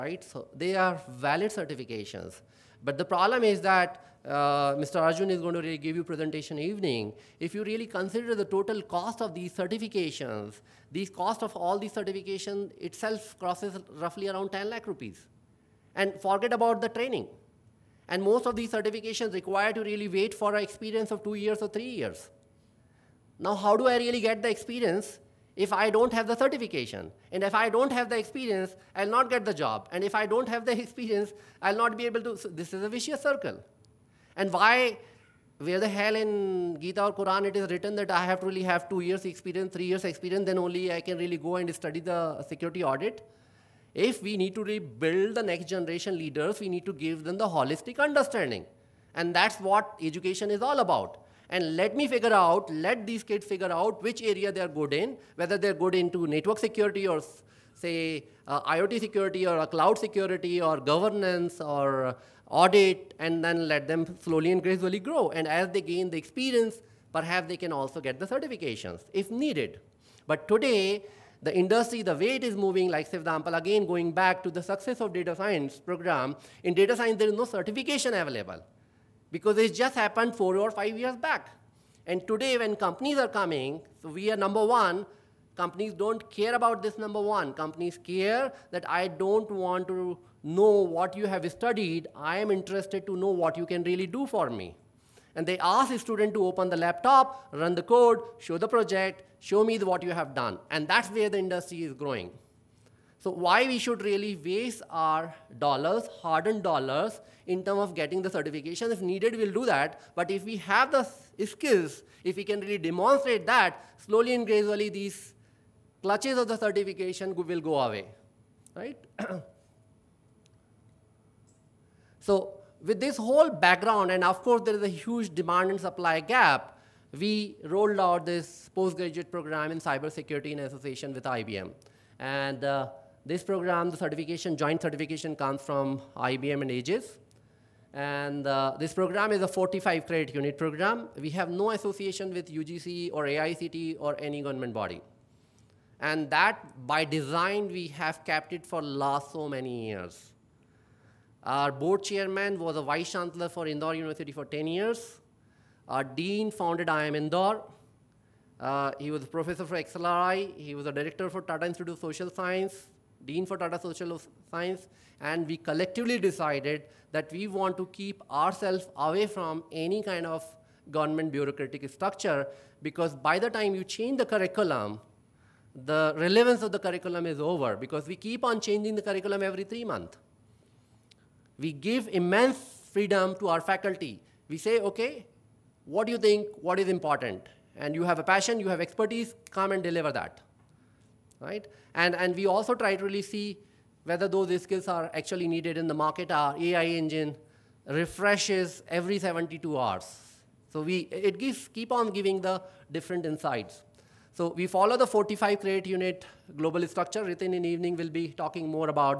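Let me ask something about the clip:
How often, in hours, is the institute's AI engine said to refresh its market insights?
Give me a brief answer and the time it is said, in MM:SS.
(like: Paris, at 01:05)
72 hours, at 03:19.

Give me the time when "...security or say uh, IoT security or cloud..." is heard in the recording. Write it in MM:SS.
00:56.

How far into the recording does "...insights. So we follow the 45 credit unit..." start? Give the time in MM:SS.
03:23.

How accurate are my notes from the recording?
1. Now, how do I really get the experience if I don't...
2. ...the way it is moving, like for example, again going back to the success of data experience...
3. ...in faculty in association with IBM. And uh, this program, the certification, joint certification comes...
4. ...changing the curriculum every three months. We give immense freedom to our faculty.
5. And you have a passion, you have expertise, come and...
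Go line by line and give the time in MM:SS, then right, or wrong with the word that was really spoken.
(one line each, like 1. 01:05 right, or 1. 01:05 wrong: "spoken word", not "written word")
1. 00:23 right
2. 01:12 wrong: "science", not "experience"
3. 02:09 wrong: "cybersecurity", not "faculty"
4. 02:58 right
5. 03:07 right.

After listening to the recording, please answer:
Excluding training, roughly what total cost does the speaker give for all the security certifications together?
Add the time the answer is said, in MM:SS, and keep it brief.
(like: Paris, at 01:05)
10 lakh rupees, at 00:14.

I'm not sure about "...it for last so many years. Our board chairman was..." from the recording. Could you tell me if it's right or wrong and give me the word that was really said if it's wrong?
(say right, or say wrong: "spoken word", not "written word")
right.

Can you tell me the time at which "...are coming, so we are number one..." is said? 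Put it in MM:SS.
01:23.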